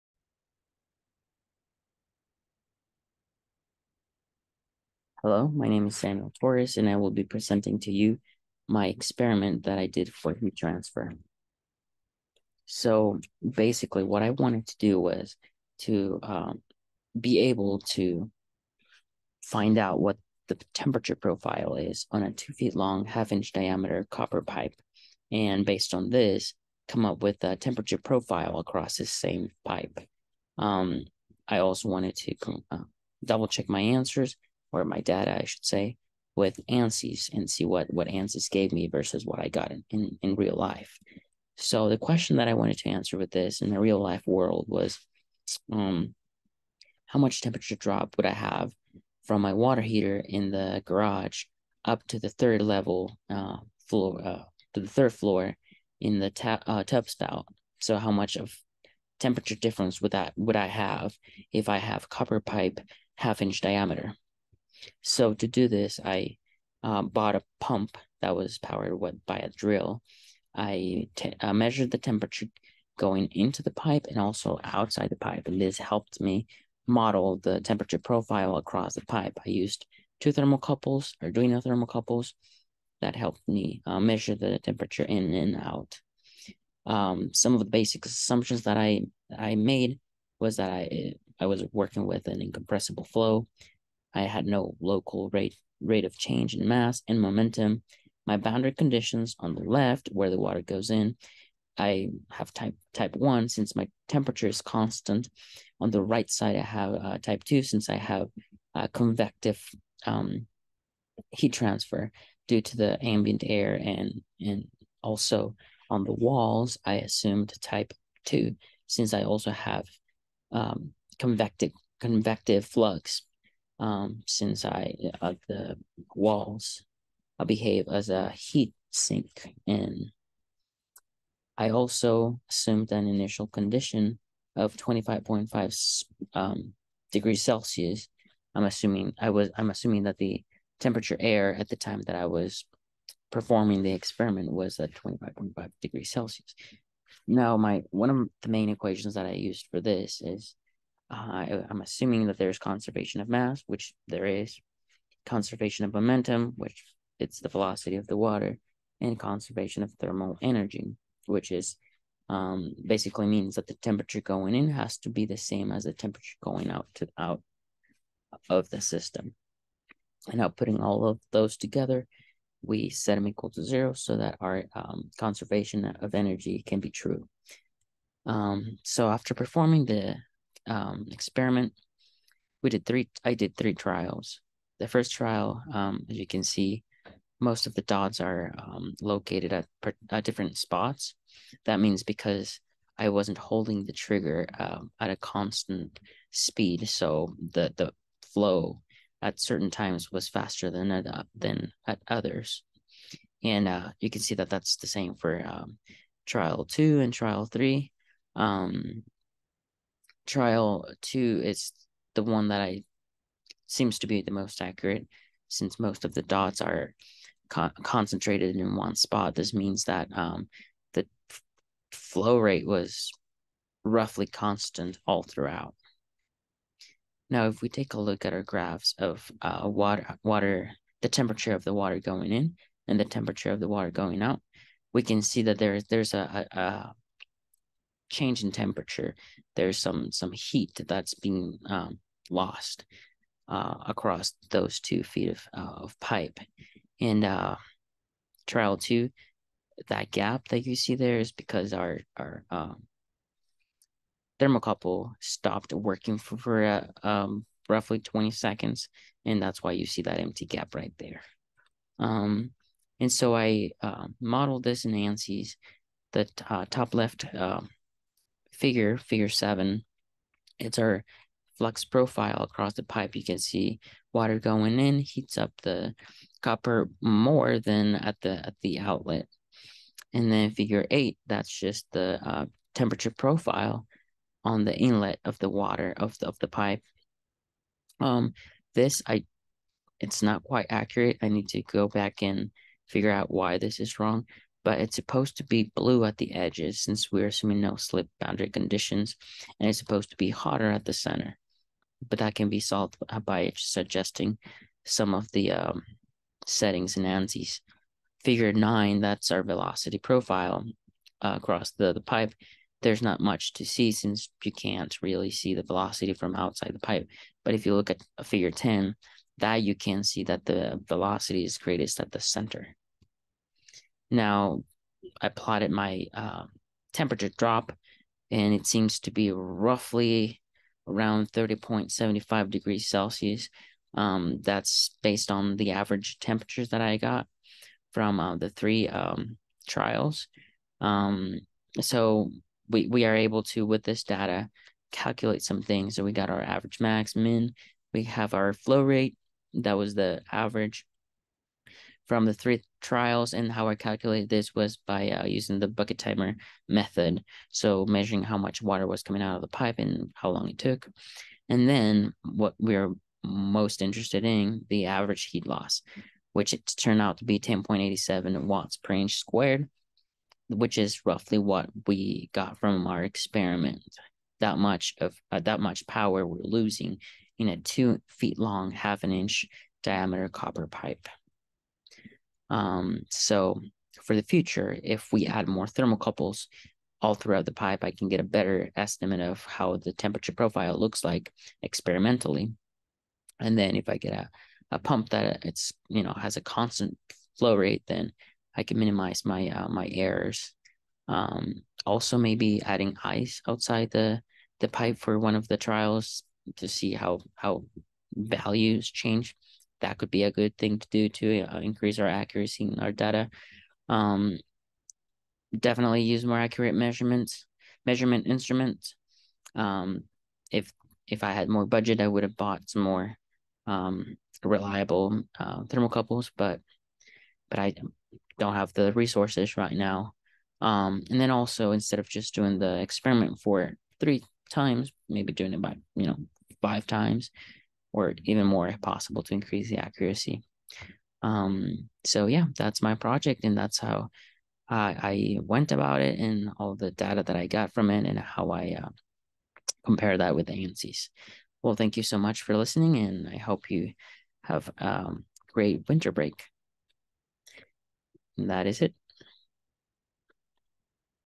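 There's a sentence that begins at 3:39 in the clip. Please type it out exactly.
This means that um, the f- flow rate was roughly constant all throughout.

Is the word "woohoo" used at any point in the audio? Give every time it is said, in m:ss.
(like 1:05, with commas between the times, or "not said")
not said.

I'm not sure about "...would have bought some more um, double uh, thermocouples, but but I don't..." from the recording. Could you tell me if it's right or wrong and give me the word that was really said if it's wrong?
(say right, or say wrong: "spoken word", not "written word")
wrong: "reliable", not "double".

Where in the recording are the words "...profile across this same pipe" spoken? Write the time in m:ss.
0:27.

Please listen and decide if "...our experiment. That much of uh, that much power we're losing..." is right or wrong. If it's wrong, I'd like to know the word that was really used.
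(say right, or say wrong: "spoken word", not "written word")
right.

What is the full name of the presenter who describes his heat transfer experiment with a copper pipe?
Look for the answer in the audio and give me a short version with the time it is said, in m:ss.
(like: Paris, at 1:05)
Samuel Torres, at 0:05.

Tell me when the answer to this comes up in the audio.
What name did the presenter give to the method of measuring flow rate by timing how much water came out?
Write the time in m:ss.
5:55.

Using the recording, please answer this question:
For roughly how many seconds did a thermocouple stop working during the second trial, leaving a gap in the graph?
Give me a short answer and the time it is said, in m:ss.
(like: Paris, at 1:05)
20, at 4:17.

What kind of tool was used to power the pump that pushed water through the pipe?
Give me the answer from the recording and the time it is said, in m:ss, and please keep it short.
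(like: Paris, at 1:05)
A drill, at 1:09.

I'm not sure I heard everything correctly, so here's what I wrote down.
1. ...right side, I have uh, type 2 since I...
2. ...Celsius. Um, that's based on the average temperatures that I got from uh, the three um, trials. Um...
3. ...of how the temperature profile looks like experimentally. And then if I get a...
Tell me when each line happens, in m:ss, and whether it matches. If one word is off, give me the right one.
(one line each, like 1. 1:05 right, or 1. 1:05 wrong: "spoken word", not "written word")
1. 1:46 right
2. 5:32 right
3. 6:29 right.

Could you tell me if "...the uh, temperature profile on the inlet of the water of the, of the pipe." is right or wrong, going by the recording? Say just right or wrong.
right.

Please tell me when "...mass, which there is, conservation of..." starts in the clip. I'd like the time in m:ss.
2:33.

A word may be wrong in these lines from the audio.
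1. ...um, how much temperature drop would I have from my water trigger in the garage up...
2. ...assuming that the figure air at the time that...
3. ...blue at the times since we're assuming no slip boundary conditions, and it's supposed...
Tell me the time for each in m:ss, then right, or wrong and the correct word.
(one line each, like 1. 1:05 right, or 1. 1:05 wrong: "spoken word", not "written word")
1. 0:45 wrong: "heater", not "trigger"
2. 2:19 wrong: "temperature", not "figure"
3. 4:55 wrong: "edges", not "times".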